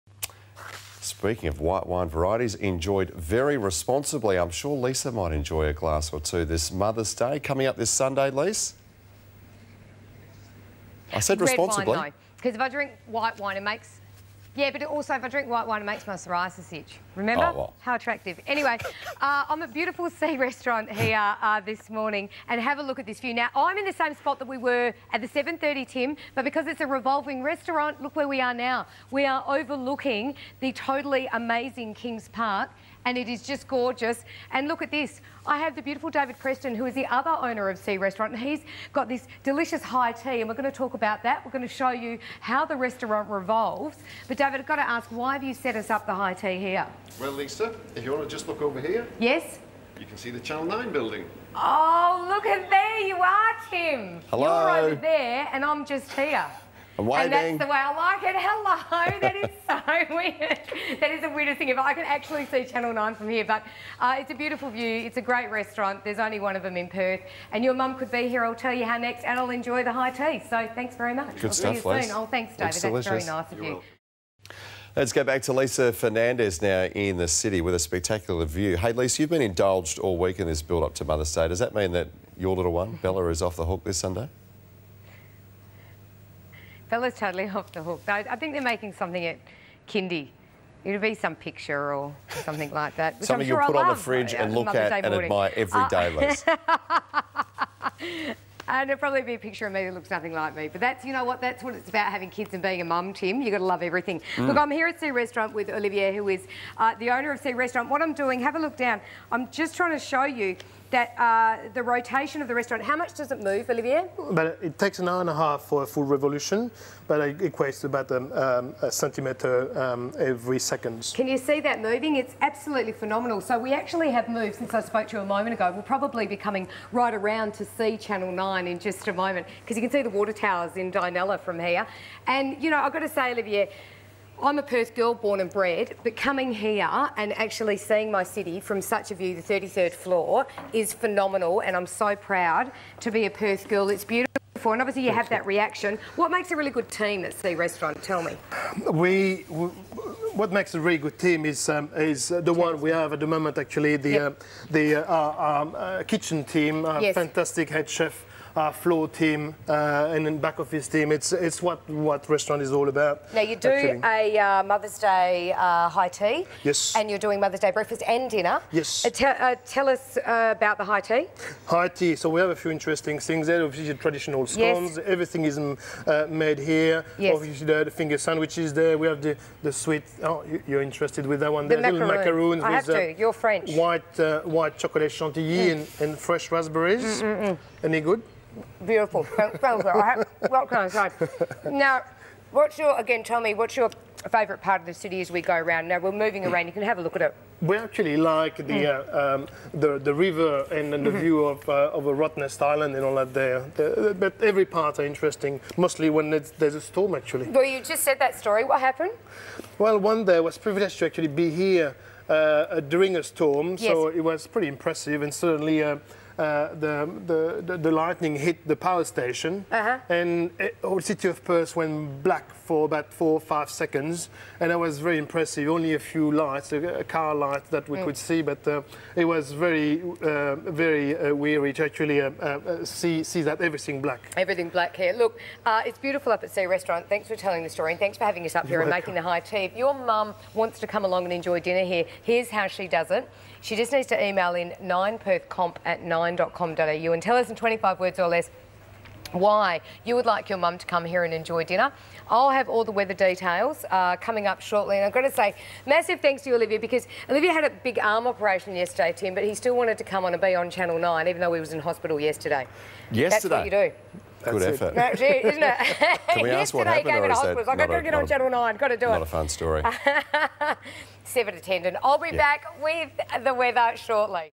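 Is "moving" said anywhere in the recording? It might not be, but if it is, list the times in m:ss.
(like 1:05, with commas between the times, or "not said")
2:01, 3:16.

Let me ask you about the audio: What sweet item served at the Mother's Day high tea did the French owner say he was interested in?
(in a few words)
Macaroons.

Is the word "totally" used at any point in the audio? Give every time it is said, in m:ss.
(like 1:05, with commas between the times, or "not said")
0:30, 1:27.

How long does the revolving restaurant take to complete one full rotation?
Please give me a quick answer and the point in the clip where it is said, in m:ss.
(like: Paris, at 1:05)
An hour and a half, at 1:54.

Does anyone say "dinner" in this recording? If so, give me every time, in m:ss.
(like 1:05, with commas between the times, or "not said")
2:48, 4:01, 4:11.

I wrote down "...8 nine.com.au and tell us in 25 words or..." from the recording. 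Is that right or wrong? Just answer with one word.
wrong.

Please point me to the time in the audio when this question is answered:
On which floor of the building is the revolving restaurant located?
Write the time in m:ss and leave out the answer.
2:19.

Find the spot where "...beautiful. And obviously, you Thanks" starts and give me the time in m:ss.
2:24.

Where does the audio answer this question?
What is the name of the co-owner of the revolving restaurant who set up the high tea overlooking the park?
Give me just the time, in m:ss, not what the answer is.
0:36.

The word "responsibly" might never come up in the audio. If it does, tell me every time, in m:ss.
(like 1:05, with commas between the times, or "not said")
0:03, 0:11.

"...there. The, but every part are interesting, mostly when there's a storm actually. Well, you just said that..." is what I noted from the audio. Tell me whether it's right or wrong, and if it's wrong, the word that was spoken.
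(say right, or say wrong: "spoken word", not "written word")
right.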